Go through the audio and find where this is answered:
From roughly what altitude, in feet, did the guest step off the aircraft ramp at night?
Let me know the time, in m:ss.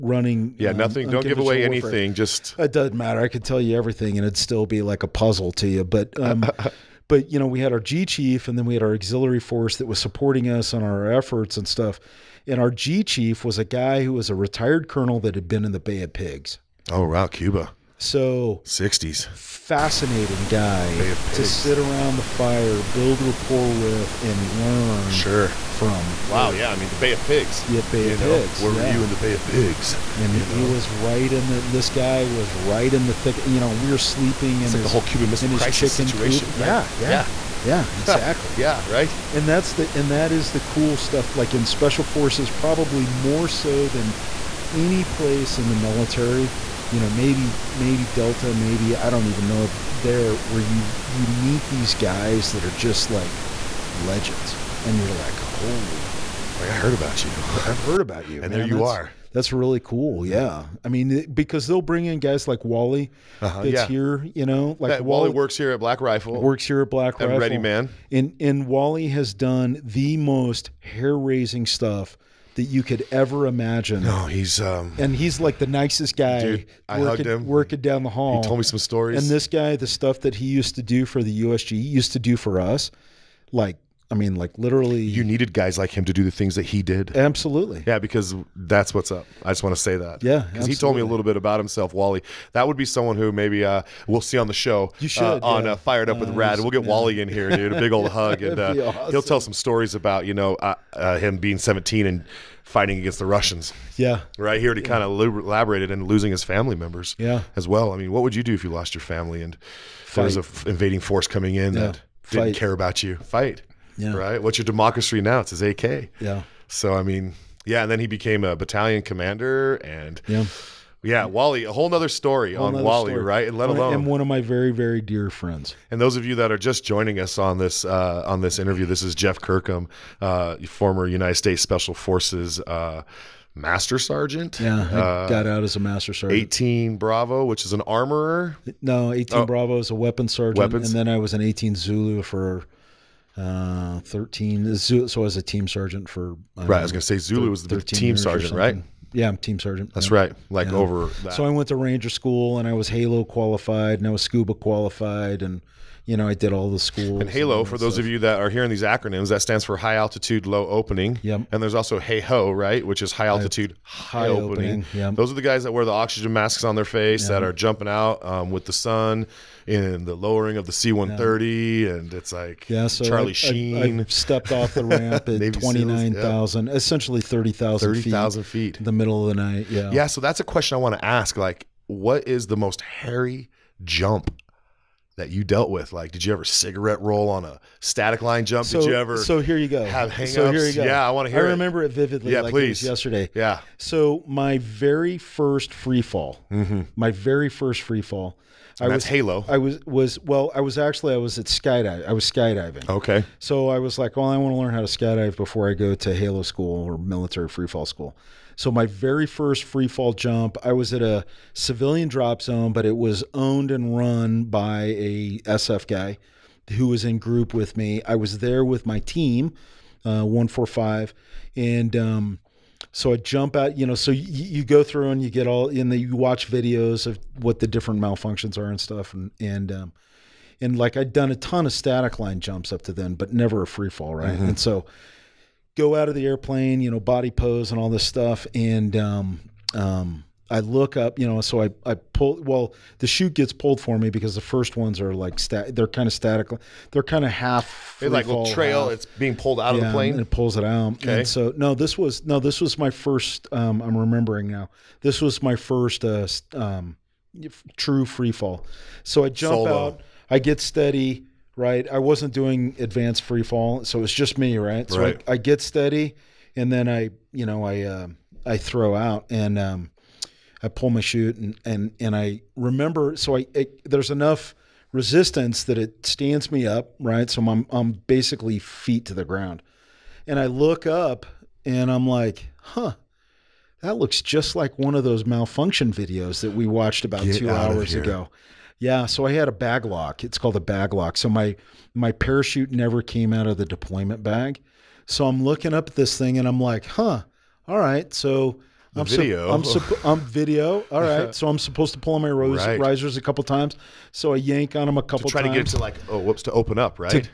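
2:55.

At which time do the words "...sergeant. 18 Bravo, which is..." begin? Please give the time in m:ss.
2:16.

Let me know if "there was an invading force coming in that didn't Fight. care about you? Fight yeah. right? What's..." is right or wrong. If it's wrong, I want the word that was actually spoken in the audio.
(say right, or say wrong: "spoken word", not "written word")
right.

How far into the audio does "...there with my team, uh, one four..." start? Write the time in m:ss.
3:38.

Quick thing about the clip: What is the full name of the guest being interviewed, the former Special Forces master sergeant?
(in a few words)
Jeff Kirkham.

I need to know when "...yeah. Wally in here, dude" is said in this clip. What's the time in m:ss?
1:36.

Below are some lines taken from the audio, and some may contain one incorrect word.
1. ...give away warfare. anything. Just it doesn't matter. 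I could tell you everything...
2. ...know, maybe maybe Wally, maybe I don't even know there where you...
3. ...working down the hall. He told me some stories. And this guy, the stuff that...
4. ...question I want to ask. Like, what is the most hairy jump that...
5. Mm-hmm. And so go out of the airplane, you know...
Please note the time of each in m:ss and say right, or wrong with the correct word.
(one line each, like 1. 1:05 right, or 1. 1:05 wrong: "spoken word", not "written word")
1. 0:01 right
2. 0:46 wrong: "Delta", not "Wally"
3. 1:17 right
4. 3:00 right
5. 3:54 right.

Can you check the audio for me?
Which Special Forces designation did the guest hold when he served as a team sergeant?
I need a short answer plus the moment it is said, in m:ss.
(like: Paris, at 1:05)
18 Zulu, at 2:21.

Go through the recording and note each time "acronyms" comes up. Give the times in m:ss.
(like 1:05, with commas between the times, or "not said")
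2:38.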